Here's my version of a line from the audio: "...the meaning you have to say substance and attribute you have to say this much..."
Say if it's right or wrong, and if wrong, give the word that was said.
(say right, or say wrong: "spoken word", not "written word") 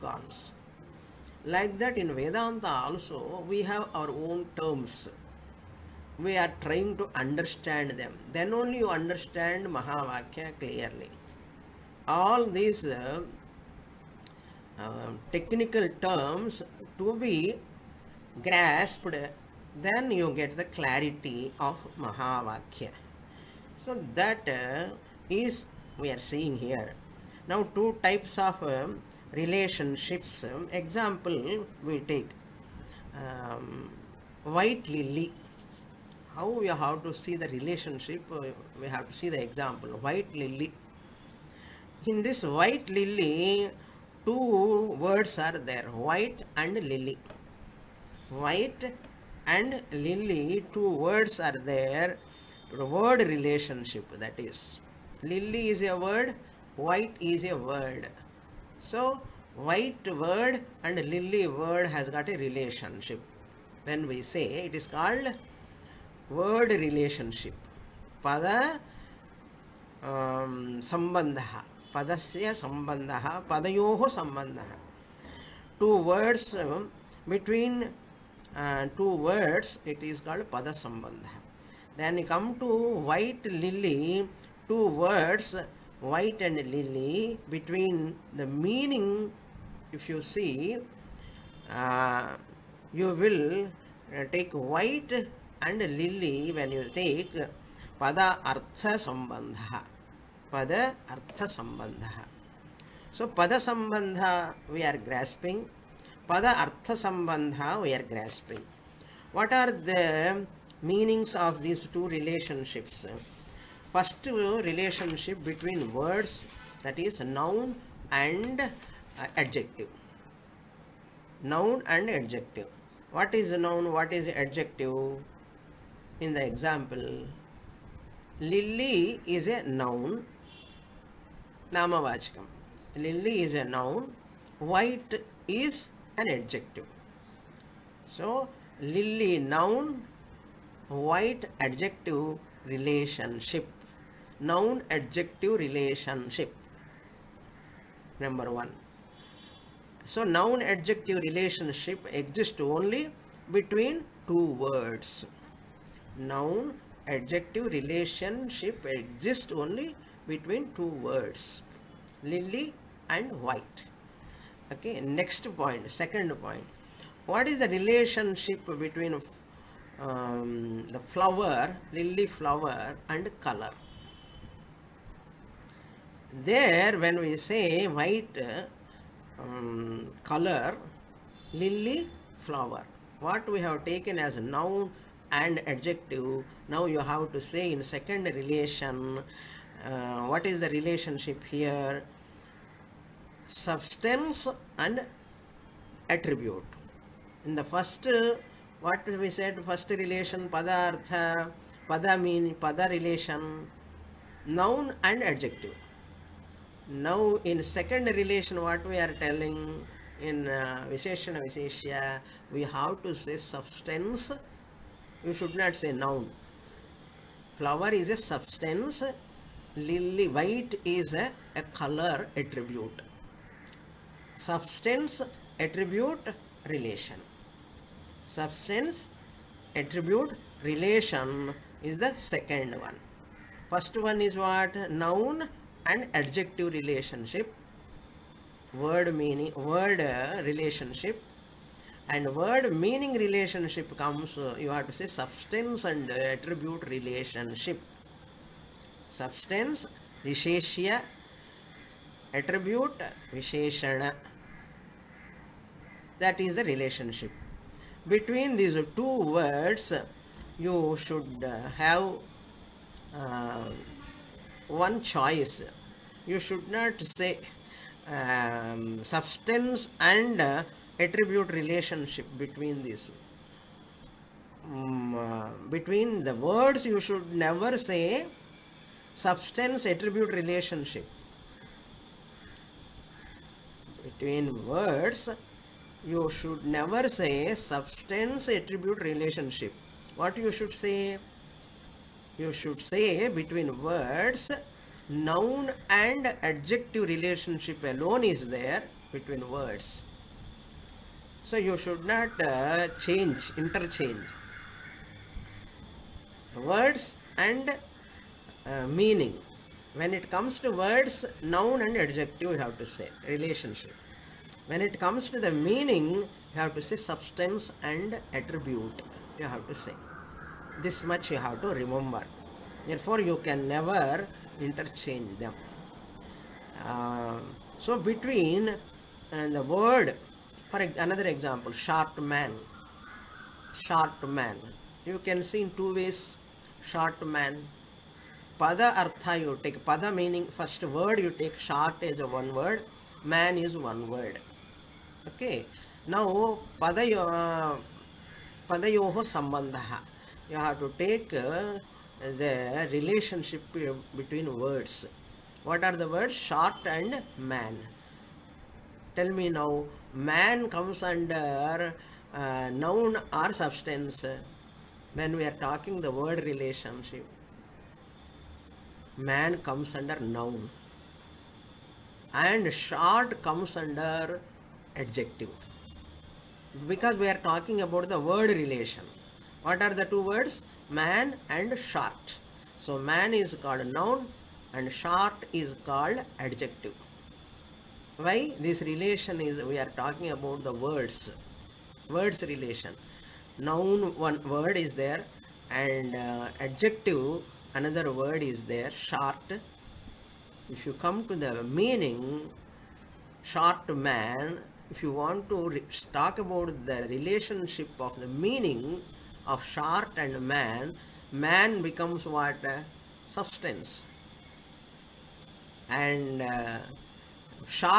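right.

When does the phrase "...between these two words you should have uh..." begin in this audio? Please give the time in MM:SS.
04:18.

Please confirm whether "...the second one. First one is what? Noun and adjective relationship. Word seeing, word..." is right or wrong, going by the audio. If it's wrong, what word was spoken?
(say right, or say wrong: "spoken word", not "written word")
wrong: "meaning", not "seeing".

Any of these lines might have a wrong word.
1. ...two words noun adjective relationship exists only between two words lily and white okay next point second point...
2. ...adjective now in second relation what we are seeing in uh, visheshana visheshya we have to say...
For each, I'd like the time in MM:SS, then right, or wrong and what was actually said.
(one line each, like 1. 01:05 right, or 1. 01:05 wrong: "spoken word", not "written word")
1. 02:34 right
2. 03:25 wrong: "telling", not "seeing".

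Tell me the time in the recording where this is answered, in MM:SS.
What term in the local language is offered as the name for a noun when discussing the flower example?
02:11.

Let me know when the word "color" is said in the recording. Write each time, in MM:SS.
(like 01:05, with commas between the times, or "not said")
02:53, 03:00, 03:41.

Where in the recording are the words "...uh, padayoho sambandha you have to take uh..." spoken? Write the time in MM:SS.
05:47.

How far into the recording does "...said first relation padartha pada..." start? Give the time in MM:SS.
03:19.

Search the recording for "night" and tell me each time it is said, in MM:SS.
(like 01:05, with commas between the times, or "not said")
not said.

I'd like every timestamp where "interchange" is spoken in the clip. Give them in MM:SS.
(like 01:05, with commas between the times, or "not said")
05:03, 05:24.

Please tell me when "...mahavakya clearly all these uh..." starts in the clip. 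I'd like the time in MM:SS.
00:09.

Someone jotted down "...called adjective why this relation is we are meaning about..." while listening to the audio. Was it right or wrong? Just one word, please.
wrong.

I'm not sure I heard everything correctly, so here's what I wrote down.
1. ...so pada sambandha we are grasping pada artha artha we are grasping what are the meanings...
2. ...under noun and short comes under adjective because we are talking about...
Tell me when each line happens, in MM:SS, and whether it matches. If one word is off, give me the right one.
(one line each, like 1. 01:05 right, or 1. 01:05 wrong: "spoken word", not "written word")
1. 01:43 wrong: "sambandha", not "artha"
2. 06:09 right.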